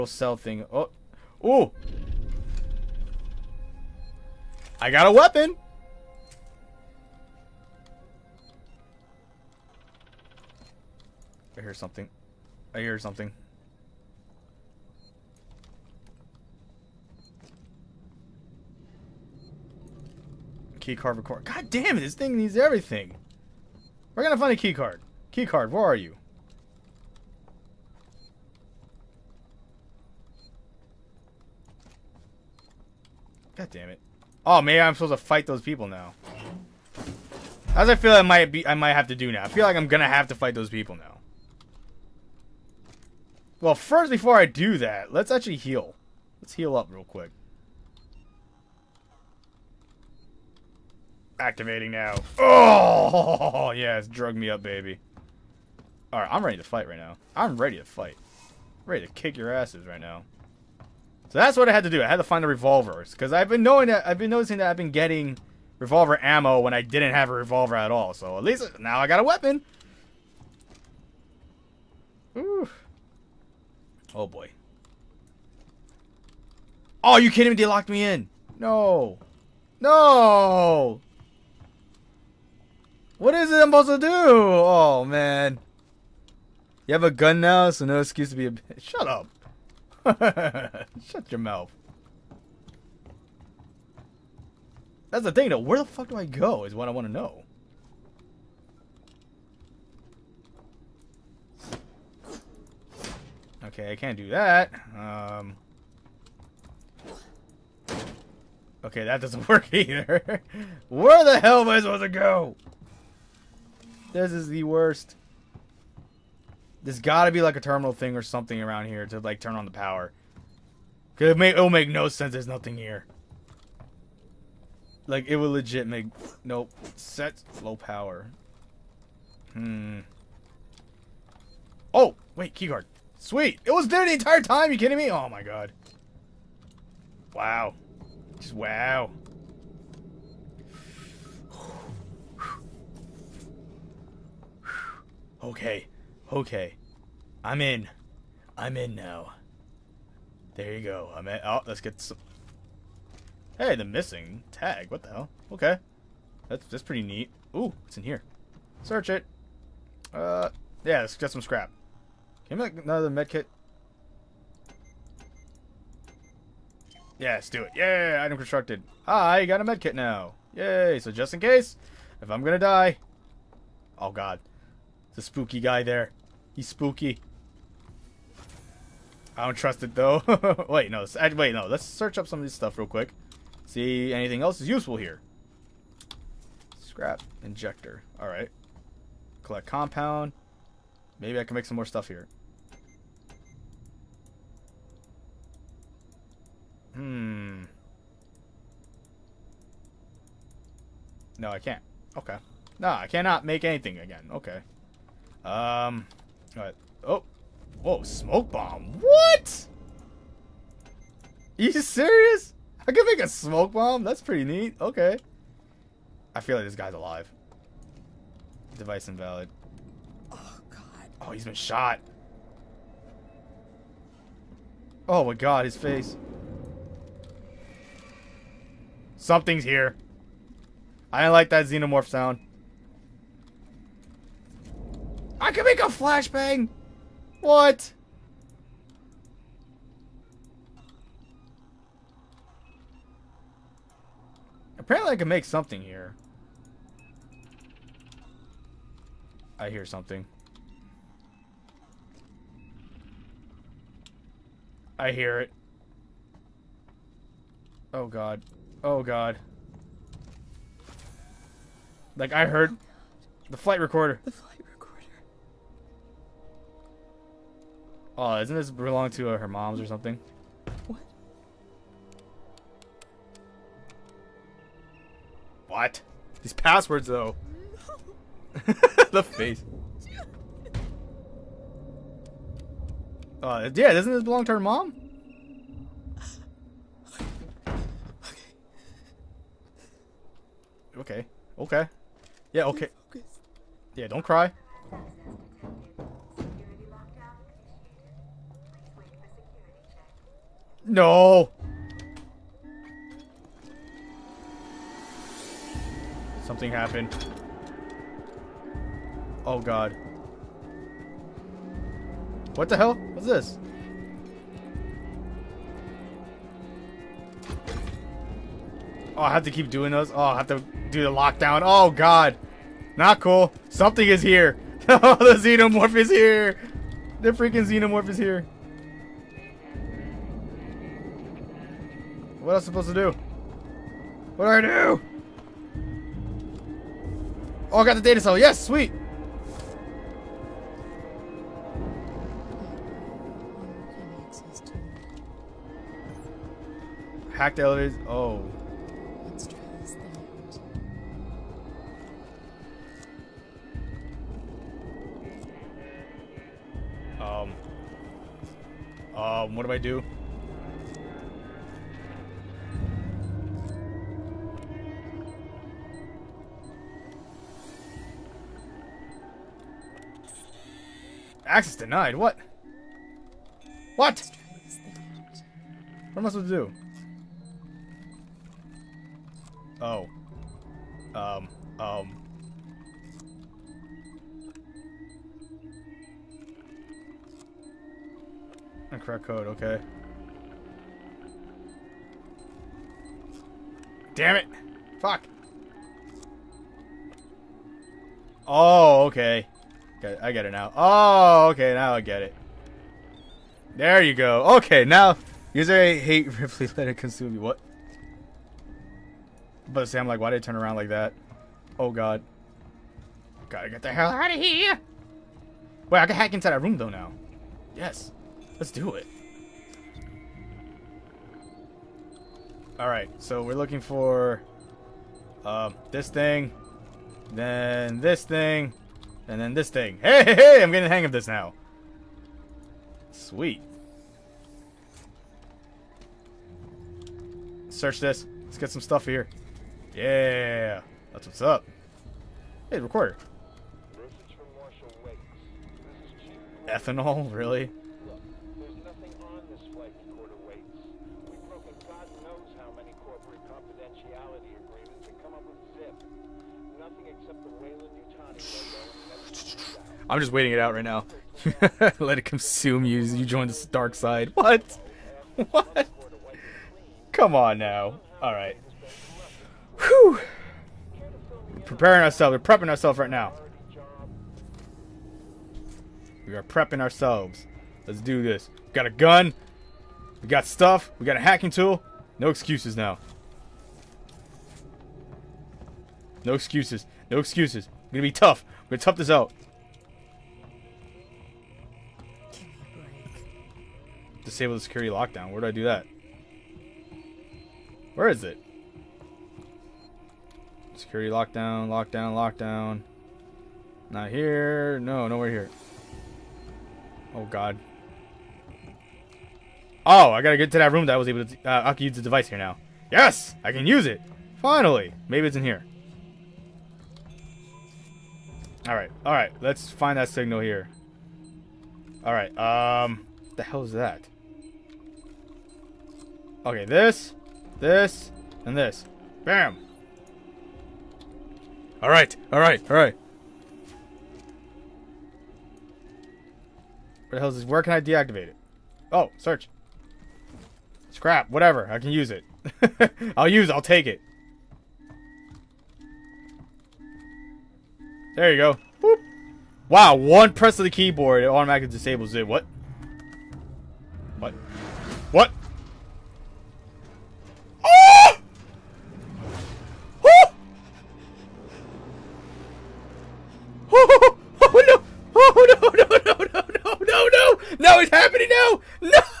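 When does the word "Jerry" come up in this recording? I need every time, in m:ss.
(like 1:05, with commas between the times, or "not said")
not said.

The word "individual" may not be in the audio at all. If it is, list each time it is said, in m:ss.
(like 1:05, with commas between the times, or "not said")
not said.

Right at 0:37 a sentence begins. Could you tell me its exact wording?
As I feel I might be I might have to do now.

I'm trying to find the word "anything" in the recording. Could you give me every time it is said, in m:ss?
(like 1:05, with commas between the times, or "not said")
3:04, 3:23.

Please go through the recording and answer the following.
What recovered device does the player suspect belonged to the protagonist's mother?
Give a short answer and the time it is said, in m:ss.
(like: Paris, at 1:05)
Flight recorder, at 4:23.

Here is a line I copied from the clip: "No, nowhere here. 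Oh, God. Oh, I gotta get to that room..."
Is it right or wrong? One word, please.
right.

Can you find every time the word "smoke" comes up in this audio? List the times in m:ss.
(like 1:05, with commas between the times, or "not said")
3:28, 3:33.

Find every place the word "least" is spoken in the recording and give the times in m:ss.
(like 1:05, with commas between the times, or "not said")
1:08.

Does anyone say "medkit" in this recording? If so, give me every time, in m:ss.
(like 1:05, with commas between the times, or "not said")
2:43, 2:49.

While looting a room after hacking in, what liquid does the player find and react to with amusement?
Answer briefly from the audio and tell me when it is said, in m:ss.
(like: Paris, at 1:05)
Ethanol, at 7:26.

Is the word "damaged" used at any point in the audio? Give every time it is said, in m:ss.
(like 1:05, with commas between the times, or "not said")
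not said.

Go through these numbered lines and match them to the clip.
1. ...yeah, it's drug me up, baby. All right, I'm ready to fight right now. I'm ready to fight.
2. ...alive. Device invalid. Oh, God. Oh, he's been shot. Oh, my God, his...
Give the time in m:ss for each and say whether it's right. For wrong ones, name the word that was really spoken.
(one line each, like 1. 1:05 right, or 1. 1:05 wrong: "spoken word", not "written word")
1. 0:53 right
2. 3:36 right.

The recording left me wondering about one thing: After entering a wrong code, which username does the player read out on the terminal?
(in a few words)
Ripley.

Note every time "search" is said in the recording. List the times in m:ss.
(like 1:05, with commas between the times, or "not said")
2:38, 3:01, 7:17, 8:59.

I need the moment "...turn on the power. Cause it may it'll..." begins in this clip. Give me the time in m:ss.
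1:59.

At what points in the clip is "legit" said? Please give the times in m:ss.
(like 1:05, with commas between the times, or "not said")
2:05.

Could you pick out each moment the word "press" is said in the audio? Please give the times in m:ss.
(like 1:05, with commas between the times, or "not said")
9:10.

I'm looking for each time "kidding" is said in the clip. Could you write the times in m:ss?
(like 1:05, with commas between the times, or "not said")
1:17, 2:14.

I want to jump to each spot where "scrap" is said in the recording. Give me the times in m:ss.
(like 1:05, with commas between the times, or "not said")
2:41, 3:06, 9:00.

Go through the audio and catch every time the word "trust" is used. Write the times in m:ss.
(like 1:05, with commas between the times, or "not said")
2:59.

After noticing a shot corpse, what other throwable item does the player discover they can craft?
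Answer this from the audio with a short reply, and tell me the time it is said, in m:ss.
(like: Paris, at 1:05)
Flashbang, at 3:55.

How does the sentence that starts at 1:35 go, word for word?
Where the fuck do I go is what I want to know.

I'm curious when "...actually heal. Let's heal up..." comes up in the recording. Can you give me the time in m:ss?
0:45.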